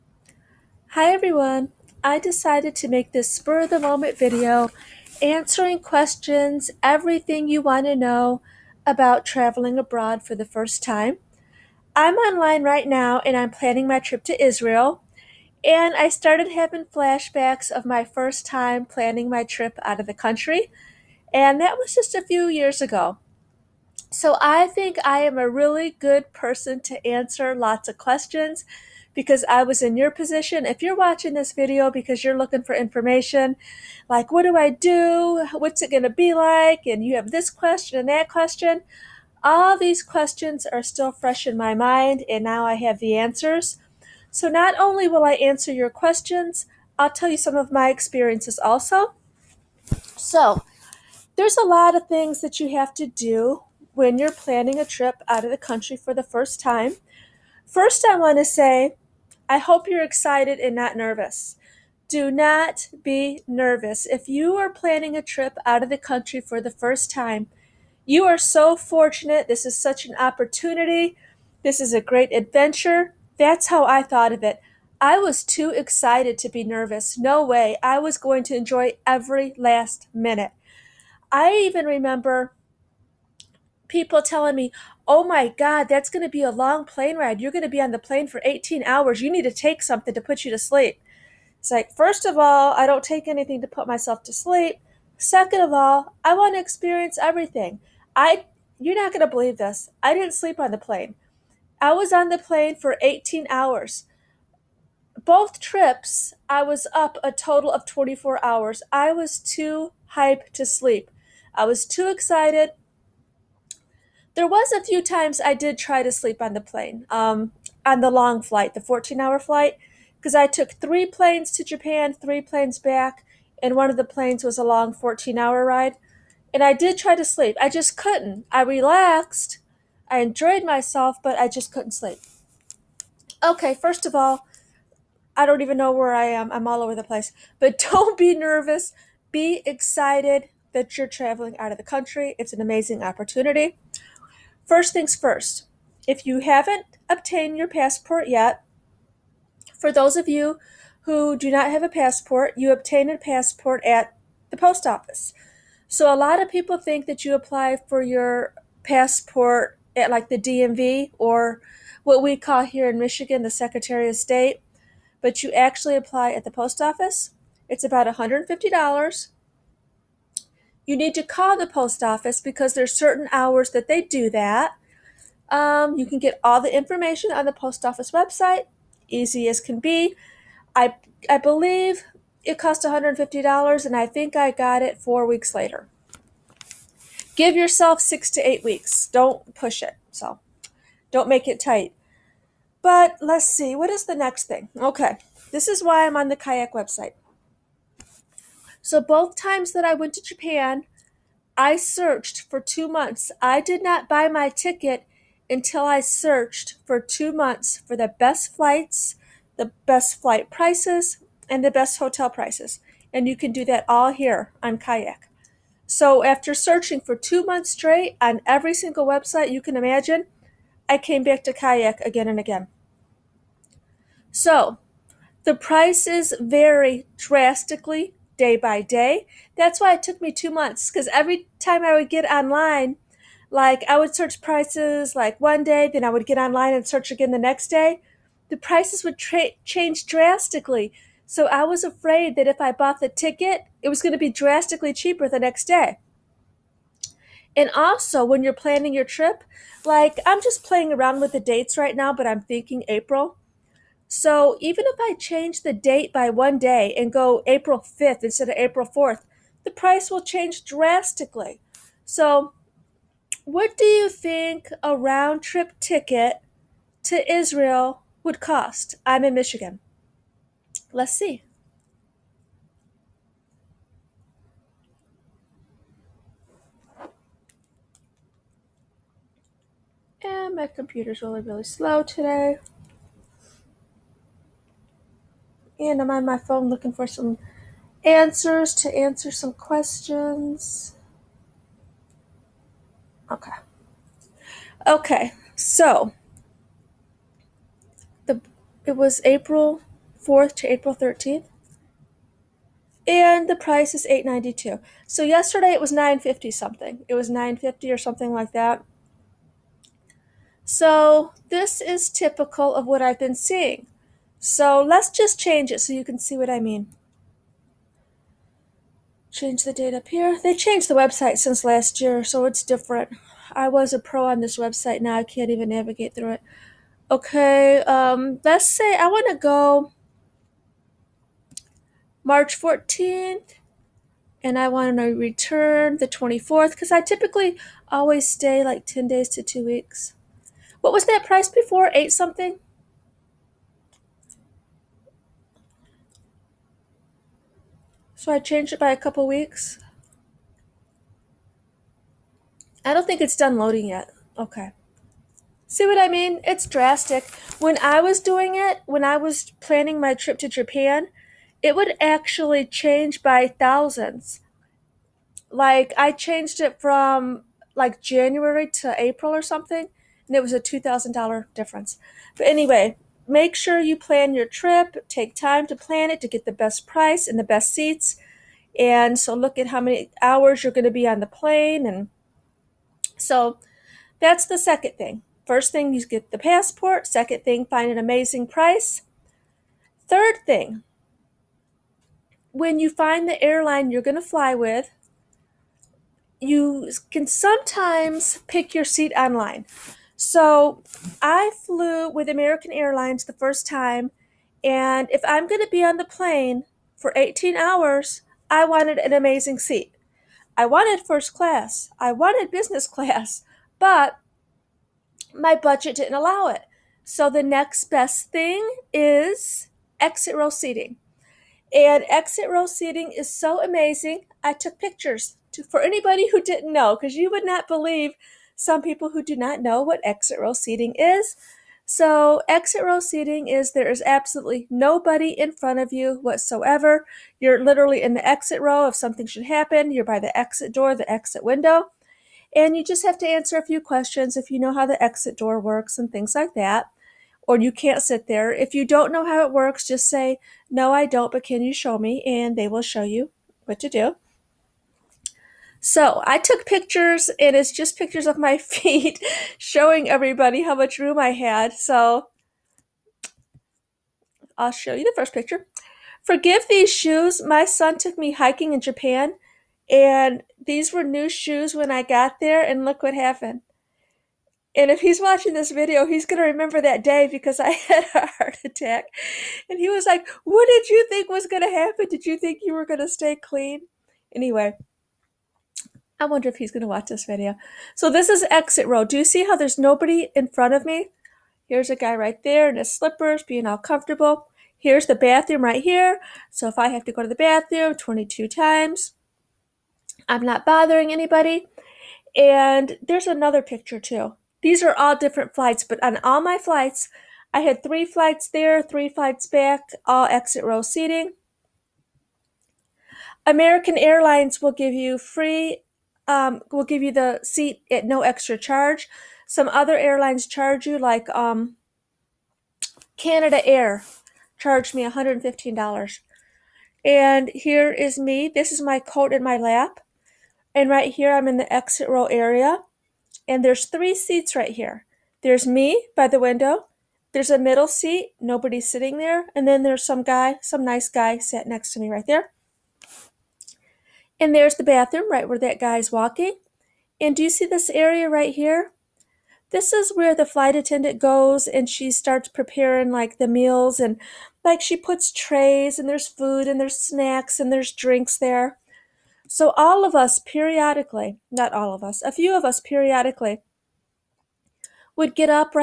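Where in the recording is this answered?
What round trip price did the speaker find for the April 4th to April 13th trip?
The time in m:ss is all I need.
5:04.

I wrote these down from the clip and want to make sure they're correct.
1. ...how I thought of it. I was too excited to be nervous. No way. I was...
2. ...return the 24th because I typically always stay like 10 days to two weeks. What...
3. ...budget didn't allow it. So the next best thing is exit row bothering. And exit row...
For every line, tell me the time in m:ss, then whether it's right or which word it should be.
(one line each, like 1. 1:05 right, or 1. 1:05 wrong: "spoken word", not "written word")
1. 1:13 right
2. 5:35 right
3. 6:55 wrong: "seating", not "bothering".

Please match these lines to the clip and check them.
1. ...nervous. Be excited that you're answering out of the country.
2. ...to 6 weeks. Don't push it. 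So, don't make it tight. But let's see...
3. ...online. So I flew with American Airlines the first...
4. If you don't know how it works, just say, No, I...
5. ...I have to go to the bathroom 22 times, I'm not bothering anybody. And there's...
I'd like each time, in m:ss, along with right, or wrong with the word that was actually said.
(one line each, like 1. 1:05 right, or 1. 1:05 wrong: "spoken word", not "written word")
1. 2:18 wrong: "traveling", not "answering"
2. 3:08 wrong: "8", not "6"
3. 6:39 right
4. 7:28 right
5. 8:16 right.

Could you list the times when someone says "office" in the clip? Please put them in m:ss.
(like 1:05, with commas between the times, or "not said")
2:34, 2:46, 2:52, 2:57.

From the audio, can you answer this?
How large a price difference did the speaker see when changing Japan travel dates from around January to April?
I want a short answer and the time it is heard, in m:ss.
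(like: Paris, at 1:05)
$2,000, at 6:10.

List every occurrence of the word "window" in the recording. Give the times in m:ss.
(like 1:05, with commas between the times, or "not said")
7:21, 8:56.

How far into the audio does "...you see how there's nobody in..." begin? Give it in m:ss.
8:09.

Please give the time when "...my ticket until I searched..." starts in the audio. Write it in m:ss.
3:24.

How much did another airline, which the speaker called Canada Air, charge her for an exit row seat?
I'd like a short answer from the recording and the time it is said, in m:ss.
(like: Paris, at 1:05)
$115, at 8:45.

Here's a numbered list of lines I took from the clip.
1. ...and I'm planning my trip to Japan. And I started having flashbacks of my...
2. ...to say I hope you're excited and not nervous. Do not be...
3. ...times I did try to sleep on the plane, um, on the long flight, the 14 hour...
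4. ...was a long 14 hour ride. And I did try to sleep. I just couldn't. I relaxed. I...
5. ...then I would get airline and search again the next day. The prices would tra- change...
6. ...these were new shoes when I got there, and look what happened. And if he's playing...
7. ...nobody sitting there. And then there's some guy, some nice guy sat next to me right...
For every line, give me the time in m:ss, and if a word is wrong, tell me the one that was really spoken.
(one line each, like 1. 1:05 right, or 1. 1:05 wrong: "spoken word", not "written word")
1. 0:13 wrong: "Israel", not "Japan"
2. 0:58 right
3. 1:55 right
4. 2:04 right
5. 3:55 wrong: "online", not "airline"
6. 7:50 wrong: "watching", not "playing"
7. 8:58 right.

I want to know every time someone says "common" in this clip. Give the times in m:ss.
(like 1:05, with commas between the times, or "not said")
not said.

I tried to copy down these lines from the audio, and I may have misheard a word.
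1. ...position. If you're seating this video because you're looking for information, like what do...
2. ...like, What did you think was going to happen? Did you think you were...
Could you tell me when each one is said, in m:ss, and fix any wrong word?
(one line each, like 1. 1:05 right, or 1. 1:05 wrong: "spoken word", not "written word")
1. 0:30 wrong: "watching", not "seating"
2. 8:00 right.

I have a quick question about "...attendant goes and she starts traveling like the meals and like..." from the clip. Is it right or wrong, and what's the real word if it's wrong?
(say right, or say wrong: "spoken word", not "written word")
wrong: "preparing", not "traveling".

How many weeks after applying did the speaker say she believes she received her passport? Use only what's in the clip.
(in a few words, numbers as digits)
4 weeks.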